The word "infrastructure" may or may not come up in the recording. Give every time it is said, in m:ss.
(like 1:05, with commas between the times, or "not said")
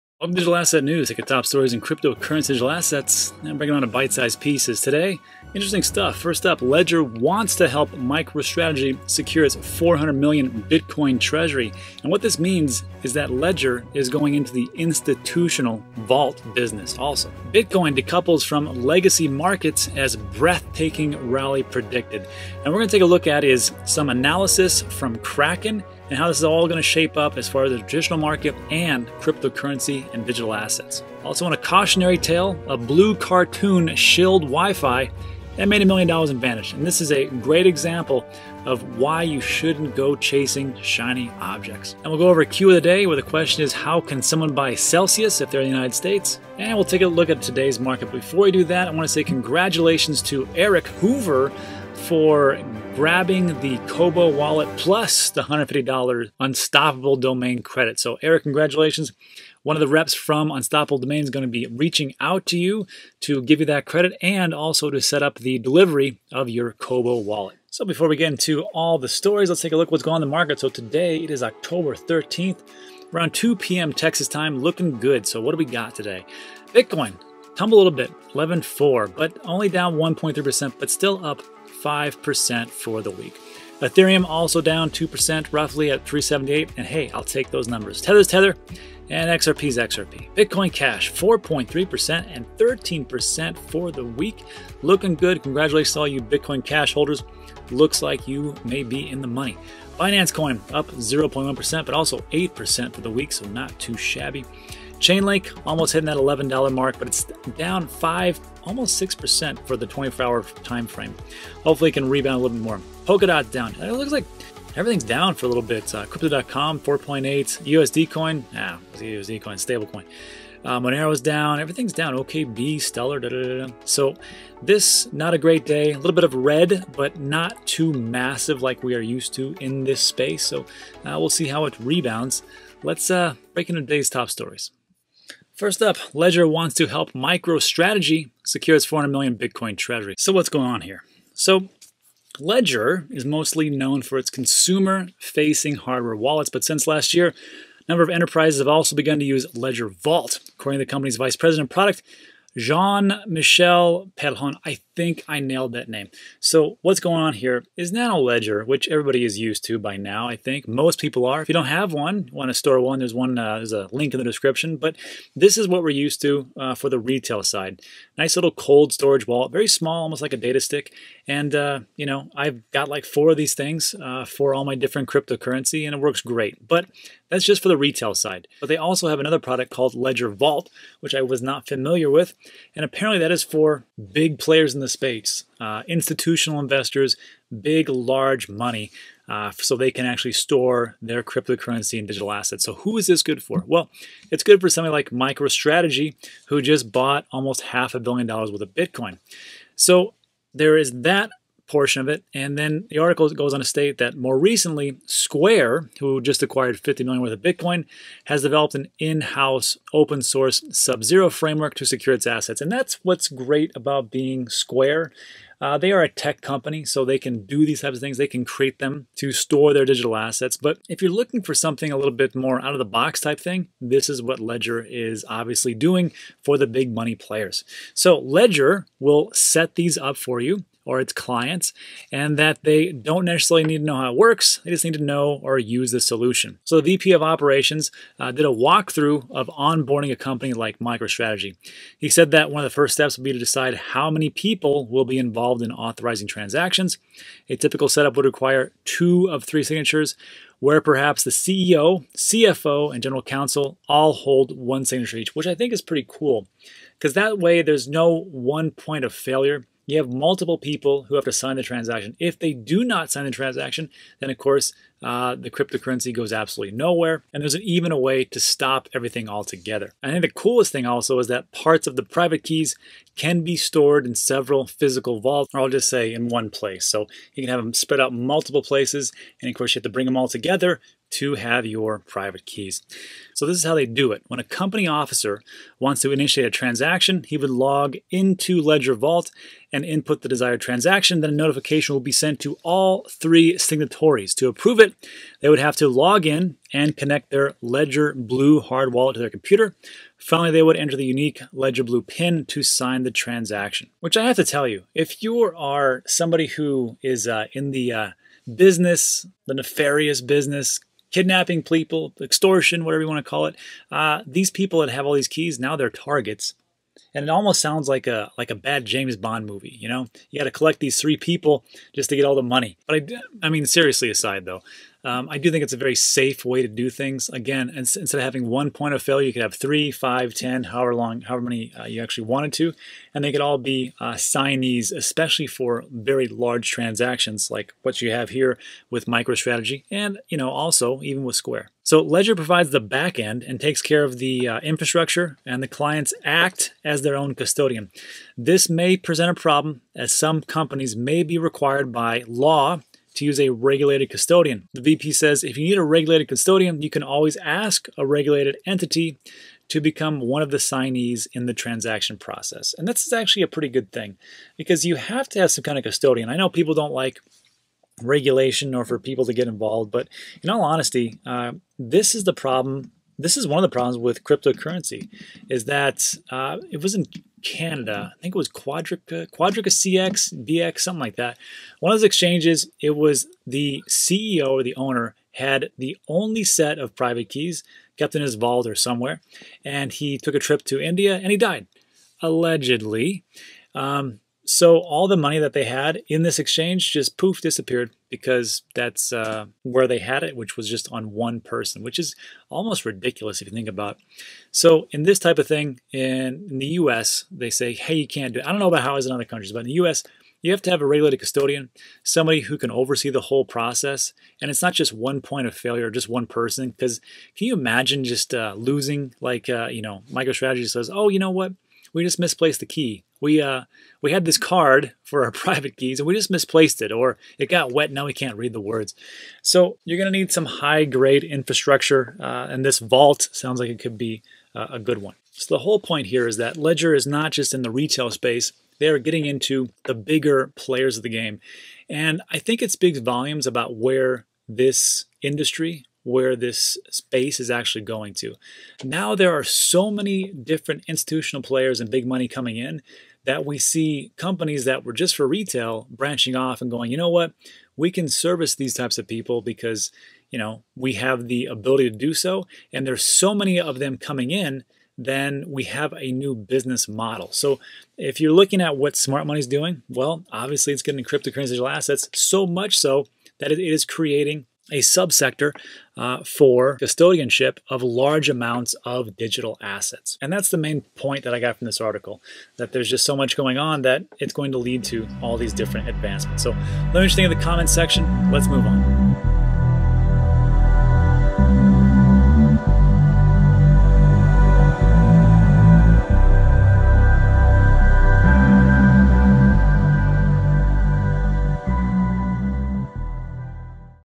5:44, 7:11.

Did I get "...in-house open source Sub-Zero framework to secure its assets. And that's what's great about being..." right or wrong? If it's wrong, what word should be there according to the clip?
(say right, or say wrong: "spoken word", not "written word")
right.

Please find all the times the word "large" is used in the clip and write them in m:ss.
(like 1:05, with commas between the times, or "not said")
3:07, 5:36, 7:57.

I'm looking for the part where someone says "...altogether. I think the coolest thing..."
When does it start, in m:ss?
4:29.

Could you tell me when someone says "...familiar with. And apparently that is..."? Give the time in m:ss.
3:01.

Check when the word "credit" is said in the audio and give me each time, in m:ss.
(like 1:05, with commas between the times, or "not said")
0:57, 1:03.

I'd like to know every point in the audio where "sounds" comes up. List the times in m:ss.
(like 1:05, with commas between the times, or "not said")
5:17, 7:13.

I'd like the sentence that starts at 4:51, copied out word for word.
Then a notification will be sent to all three signatories.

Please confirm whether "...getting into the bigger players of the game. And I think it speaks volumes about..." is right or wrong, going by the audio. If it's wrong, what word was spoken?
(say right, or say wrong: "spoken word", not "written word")
right.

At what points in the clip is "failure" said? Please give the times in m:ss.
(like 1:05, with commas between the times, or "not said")
4:19, 5:29, 6:55.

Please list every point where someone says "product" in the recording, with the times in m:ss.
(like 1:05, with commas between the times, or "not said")
2:31, 2:59.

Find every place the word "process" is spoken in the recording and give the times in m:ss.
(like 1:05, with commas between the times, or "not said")
6:02, 6:53.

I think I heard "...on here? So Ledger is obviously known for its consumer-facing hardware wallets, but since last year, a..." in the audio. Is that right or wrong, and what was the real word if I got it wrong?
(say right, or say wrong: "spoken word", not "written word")
wrong: "mostly", not "obviously".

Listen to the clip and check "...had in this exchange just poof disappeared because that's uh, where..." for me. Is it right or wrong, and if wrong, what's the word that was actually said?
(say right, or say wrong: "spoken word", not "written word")
right.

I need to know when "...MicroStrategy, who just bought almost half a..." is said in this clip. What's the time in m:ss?
3:15.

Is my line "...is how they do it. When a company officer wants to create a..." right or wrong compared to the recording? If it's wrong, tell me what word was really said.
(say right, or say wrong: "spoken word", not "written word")
wrong: "initiate", not "create".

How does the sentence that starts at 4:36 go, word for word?
So you can have them spread out multiple places.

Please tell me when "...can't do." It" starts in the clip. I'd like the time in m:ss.
6:48.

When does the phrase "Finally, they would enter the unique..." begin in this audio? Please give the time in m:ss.
5:00.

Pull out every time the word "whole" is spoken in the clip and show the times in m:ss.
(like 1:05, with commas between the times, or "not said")
6:53, 7:15.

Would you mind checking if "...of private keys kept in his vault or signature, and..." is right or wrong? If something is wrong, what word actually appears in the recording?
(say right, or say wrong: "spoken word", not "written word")
wrong: "somewhere", not "signature".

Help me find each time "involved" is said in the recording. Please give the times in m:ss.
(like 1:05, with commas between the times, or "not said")
4:05, 6:09.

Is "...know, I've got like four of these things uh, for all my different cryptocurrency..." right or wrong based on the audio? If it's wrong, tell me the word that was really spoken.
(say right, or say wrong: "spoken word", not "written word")
right.